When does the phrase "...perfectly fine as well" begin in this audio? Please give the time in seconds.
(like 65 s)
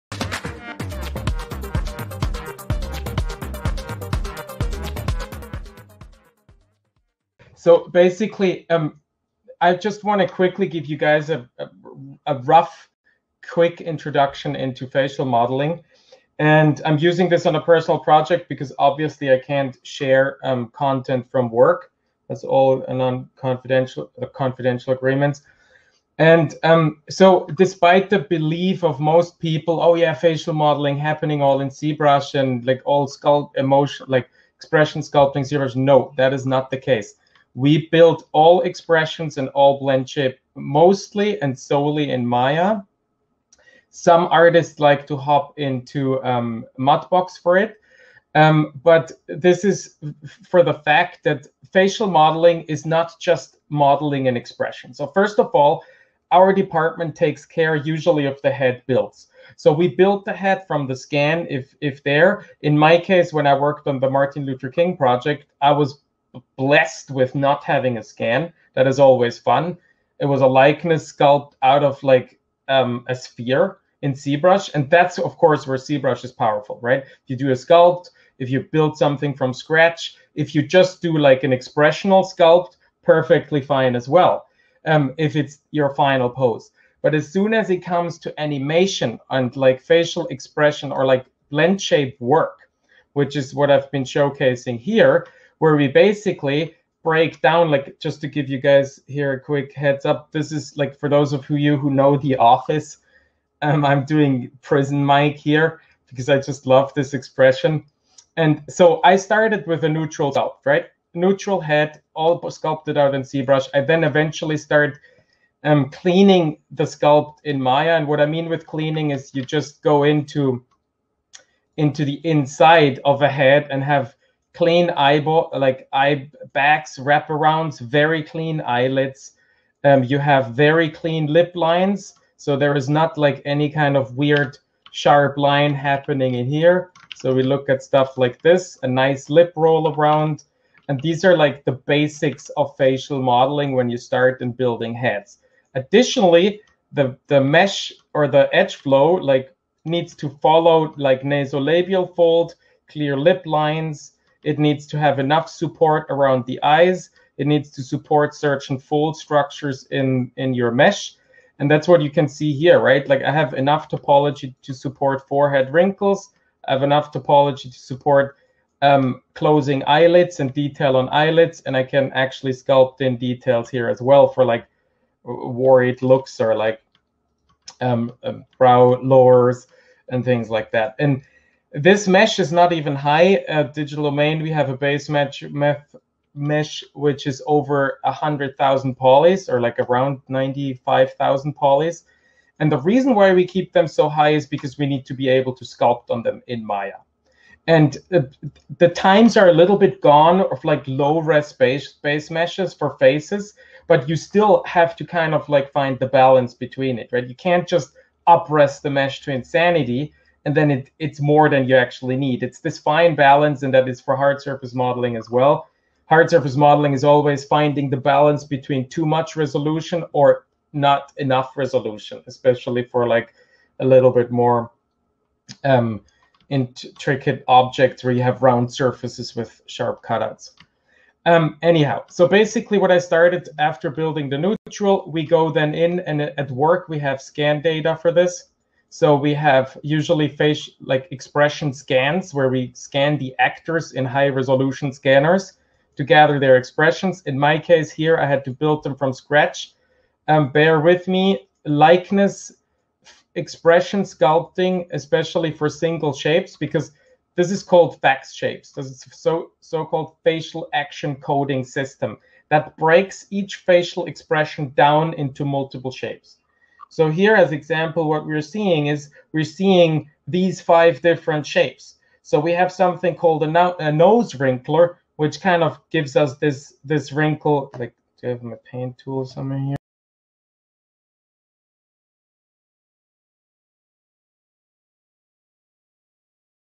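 83 s.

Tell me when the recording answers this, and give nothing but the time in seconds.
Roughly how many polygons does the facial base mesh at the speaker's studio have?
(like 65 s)
190 s.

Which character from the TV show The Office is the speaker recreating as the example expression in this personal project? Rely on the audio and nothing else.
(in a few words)
Prison Mike.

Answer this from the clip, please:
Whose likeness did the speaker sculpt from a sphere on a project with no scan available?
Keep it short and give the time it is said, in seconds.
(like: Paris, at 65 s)
Martin Luther King, at 64 s.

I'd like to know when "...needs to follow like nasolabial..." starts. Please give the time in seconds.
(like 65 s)
149 s.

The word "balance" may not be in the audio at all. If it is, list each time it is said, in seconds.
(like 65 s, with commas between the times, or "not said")
206 s, 213 s, 217 s.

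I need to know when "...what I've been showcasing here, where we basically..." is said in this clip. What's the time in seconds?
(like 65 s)
93 s.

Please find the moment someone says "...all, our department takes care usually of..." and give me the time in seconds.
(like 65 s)
55 s.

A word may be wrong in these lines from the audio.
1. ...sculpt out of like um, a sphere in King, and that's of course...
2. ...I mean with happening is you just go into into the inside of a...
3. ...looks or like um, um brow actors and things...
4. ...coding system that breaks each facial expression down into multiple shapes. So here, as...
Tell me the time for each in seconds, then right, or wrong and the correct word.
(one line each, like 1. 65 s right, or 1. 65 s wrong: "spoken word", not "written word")
1. 71 s wrong: "ZBrush", not "King"
2. 118 s wrong: "cleaning", not "happening"
3. 176 s wrong: "lowers", not "actors"
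4. 261 s right.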